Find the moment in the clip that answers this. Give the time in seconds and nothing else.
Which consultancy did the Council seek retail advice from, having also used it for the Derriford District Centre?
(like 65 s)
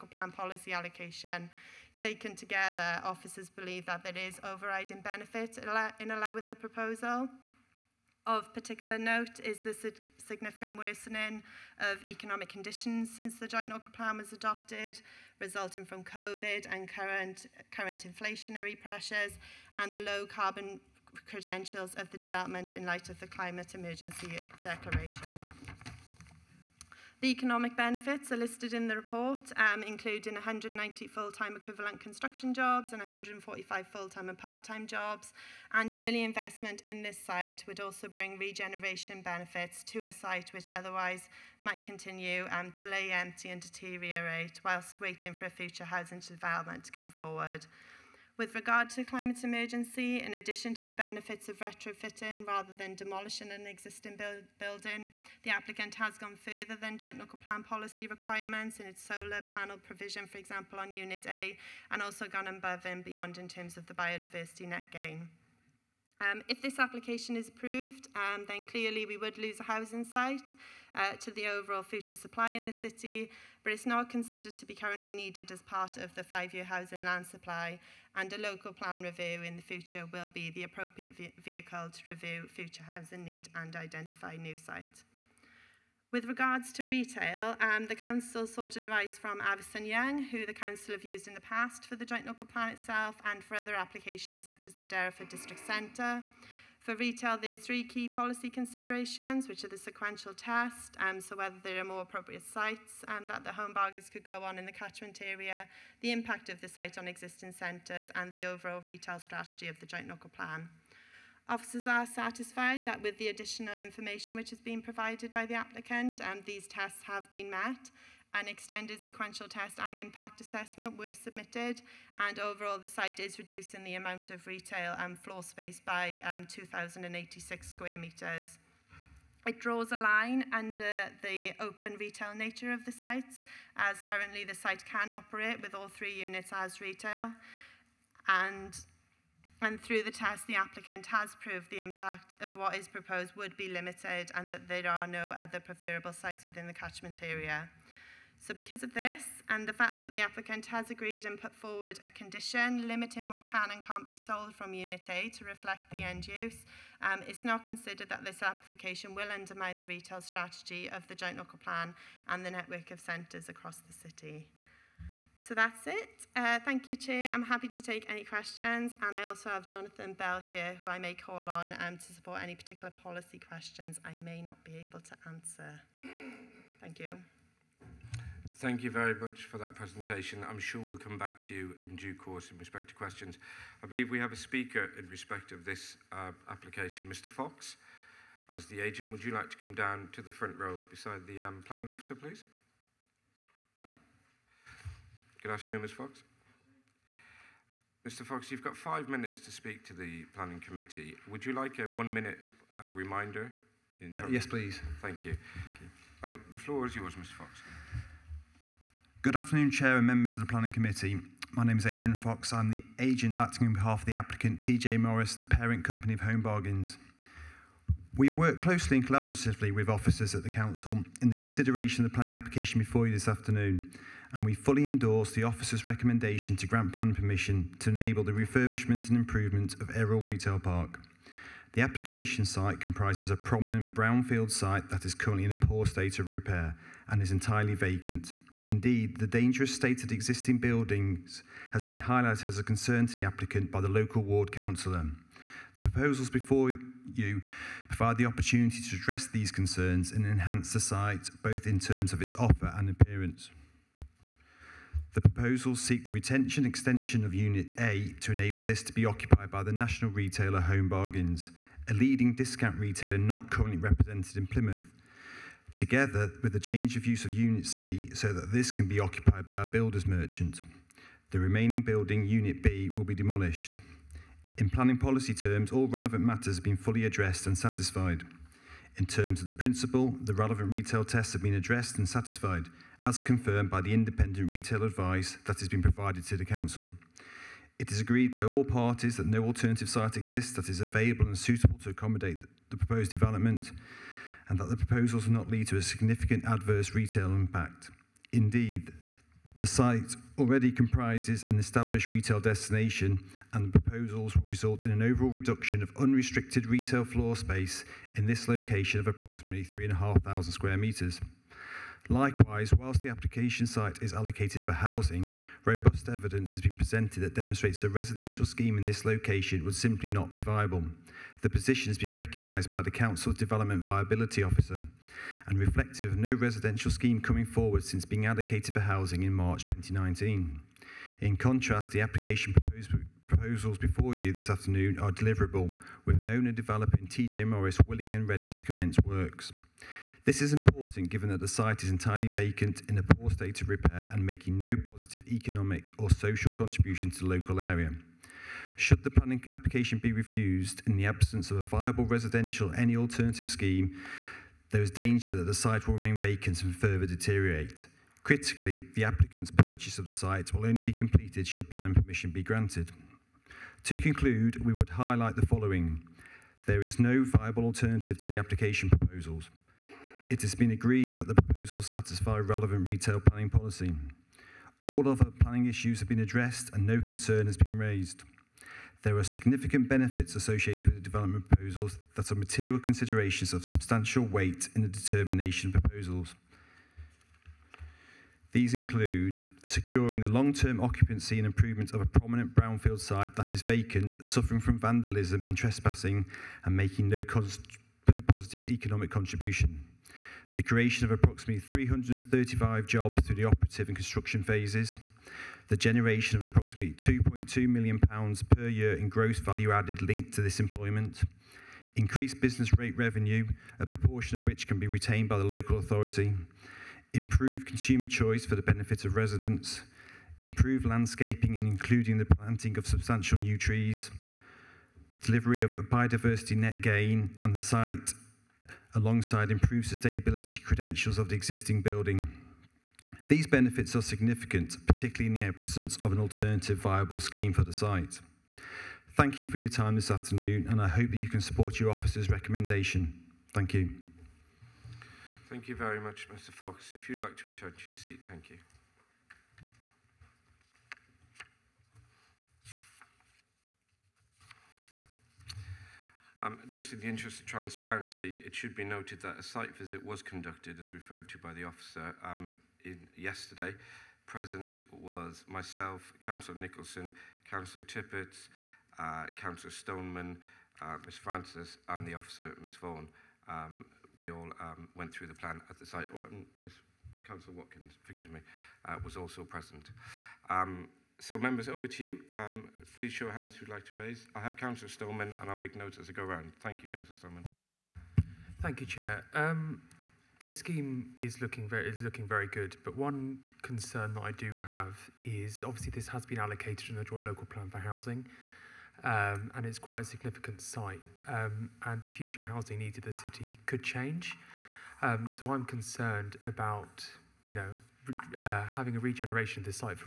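89 s.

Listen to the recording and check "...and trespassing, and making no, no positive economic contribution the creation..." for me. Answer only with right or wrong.
right.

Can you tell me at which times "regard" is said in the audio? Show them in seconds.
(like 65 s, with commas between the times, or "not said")
48 s, 86 s.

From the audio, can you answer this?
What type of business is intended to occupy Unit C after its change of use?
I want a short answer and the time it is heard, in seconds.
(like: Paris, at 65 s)
Builder's merchant, at 269 s.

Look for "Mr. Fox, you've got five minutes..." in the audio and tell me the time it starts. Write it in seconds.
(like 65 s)
198 s.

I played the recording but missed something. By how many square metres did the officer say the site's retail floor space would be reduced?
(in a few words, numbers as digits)
2,086.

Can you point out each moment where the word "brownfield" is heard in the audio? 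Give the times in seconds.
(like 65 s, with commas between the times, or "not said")
233 s, 392 s.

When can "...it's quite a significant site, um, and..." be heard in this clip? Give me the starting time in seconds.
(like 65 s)
499 s.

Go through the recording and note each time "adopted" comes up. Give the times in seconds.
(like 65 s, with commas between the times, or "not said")
14 s.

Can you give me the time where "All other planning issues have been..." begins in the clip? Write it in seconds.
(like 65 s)
374 s.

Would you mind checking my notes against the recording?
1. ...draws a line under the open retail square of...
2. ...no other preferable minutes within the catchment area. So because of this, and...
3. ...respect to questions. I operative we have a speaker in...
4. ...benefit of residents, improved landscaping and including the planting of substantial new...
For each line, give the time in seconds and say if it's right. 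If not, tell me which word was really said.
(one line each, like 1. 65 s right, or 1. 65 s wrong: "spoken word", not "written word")
1. 129 s wrong: "nature", not "square"
2. 145 s wrong: "sites", not "minutes"
3. 182 s wrong: "believe", not "operative"
4. 418 s right.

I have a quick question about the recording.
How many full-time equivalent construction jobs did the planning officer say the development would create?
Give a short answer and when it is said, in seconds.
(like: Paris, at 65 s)
190, at 30 s.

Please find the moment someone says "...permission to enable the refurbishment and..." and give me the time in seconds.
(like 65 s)
227 s.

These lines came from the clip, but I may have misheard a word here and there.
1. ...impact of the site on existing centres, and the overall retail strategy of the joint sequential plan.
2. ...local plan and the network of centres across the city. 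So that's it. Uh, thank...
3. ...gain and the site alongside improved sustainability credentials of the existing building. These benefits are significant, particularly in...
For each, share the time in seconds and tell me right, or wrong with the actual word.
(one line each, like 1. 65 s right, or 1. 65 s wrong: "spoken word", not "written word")
1. 106 s wrong: "local", not "sequential"
2. 161 s right
3. 426 s right.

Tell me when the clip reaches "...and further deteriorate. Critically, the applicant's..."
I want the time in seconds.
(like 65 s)
356 s.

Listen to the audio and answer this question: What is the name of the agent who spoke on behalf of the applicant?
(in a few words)
Adrian Fox.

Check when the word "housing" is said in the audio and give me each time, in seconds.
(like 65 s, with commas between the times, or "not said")
45 s, 69 s, 76 s, 82 s, 314 s, 328 s, 497 s, 502 s.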